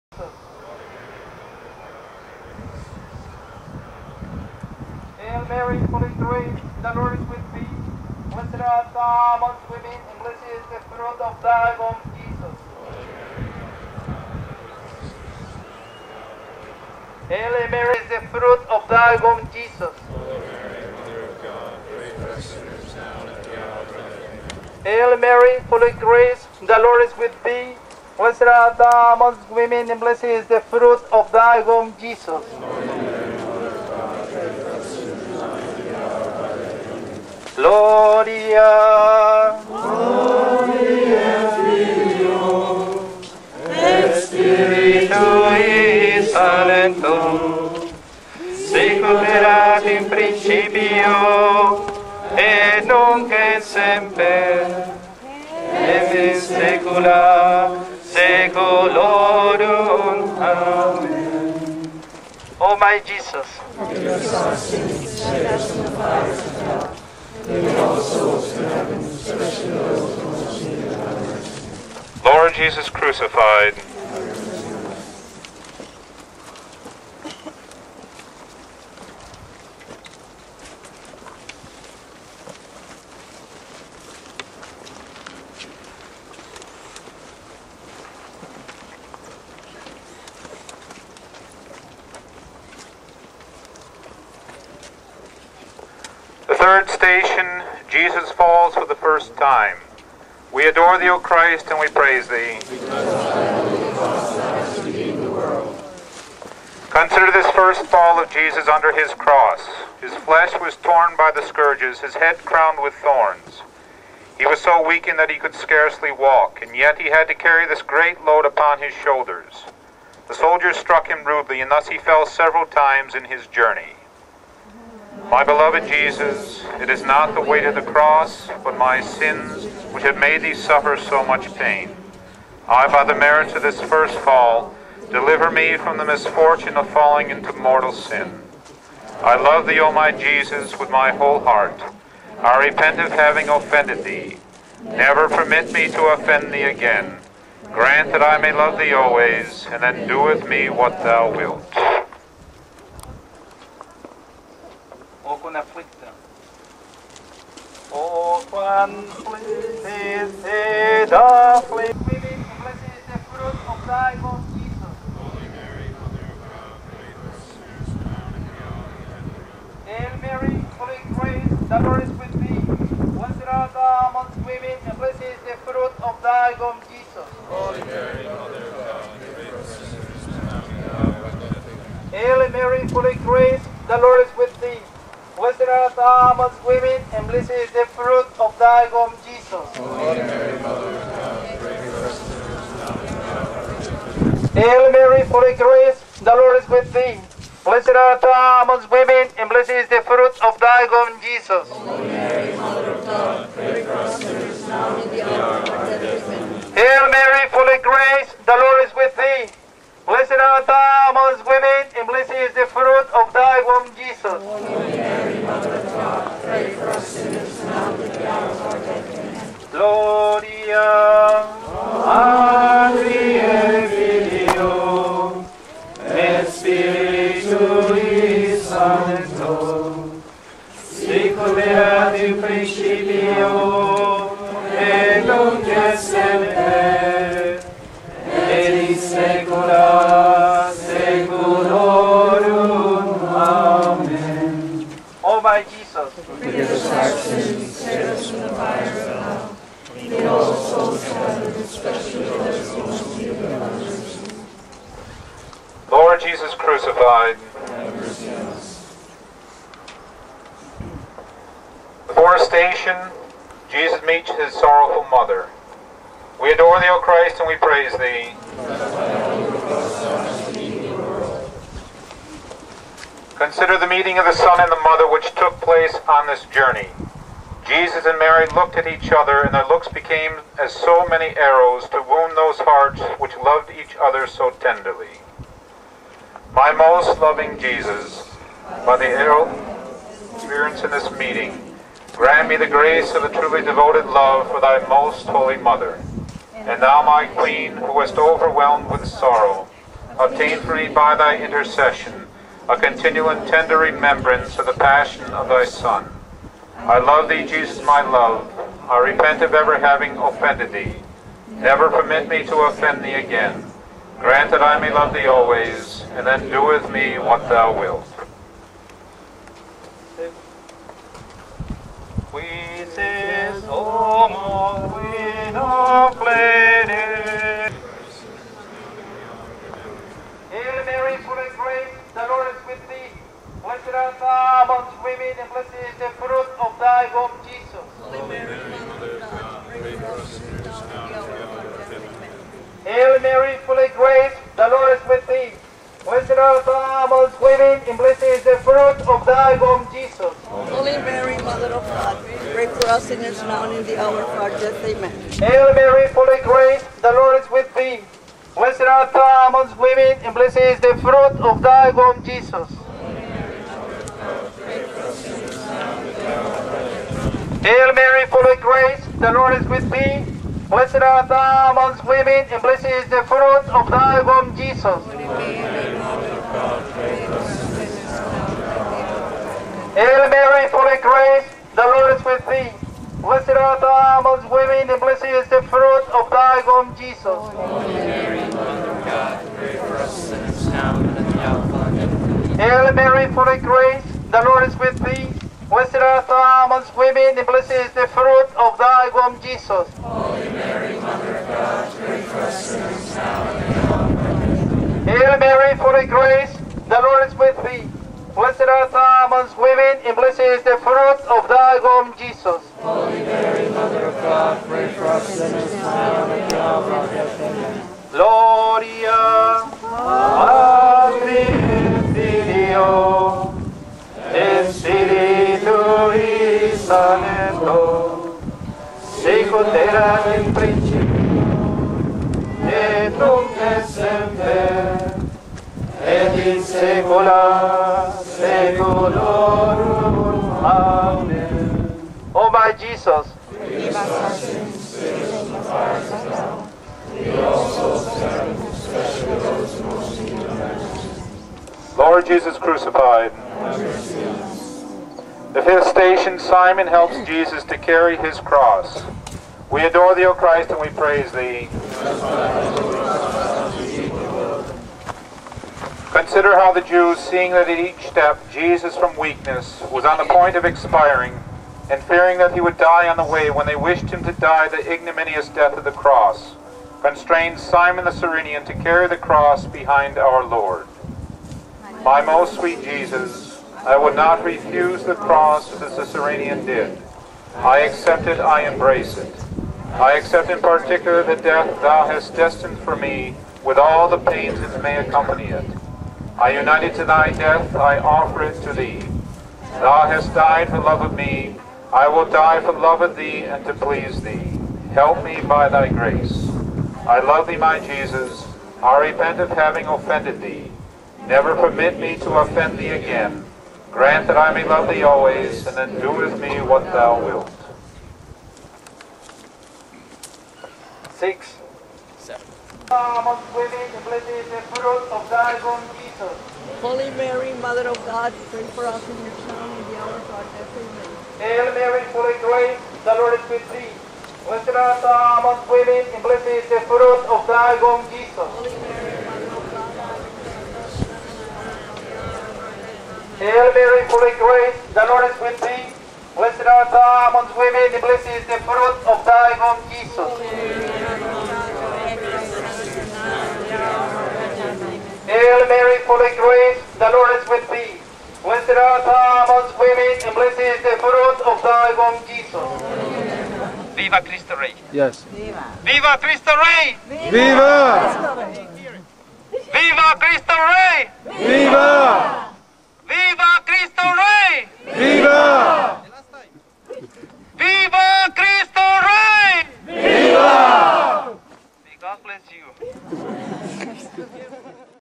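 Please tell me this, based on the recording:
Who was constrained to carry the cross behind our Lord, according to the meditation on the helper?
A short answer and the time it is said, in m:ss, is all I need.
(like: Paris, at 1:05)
Simon the Cyrenian, at 7:57.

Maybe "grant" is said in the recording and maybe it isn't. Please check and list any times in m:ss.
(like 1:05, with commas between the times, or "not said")
2:27, 4:52, 5:14, 8:33.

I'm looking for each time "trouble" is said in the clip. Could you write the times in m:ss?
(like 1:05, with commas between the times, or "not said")
not said.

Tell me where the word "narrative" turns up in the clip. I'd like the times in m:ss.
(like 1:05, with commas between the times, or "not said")
not said.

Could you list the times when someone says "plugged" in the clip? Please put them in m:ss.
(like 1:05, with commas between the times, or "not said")
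not said.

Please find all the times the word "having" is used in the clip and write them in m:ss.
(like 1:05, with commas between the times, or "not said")
2:23, 5:09, 8:29.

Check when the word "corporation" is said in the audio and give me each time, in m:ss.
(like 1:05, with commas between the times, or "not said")
not said.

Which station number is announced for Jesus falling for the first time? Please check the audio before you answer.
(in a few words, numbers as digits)
3.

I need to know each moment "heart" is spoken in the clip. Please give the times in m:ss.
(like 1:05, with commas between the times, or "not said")
2:21, 4:42.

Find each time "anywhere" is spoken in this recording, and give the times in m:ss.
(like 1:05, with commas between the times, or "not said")
not said.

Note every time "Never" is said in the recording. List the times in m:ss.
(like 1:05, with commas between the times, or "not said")
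2:24, 5:11, 8:31.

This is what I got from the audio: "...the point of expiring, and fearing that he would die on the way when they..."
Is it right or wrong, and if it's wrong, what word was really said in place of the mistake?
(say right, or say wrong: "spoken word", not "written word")
right.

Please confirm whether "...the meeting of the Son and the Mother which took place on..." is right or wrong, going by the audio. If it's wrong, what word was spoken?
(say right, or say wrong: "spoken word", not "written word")
right.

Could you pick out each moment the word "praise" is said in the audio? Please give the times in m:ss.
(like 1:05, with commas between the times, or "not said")
1:41, 4:27, 7:40.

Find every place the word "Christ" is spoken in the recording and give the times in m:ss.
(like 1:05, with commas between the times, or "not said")
1:41, 4:27, 7:40.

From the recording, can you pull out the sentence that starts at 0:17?
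Hail Mary is the fruit of thy womb, Jesus.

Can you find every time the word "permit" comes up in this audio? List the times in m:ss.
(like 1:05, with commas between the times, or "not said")
2:25, 5:11, 8:31.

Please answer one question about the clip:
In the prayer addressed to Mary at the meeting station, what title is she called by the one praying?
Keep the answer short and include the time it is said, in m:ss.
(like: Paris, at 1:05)
my queen, at 4:57.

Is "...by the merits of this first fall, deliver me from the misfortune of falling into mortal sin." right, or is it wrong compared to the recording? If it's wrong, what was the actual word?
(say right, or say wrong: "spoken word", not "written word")
right.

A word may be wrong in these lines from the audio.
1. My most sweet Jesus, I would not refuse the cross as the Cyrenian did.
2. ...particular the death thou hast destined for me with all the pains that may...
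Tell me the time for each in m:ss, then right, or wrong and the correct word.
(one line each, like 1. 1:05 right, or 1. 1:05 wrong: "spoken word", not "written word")
1. 8:02 right
2. 8:10 right.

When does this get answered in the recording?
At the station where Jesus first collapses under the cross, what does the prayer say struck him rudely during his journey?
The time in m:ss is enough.
2:00.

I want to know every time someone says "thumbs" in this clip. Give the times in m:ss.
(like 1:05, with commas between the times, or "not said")
not said.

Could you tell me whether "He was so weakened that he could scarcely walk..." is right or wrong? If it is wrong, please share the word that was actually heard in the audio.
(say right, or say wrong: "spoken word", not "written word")
right.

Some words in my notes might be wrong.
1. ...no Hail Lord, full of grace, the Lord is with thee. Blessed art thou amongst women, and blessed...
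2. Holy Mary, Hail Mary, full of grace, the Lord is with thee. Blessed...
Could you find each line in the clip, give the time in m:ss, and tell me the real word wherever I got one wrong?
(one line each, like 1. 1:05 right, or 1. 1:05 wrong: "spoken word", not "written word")
1. 5:25 wrong: "Mary", not "Lord"
2. 8:58 right.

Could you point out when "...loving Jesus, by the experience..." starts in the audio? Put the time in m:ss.
4:47.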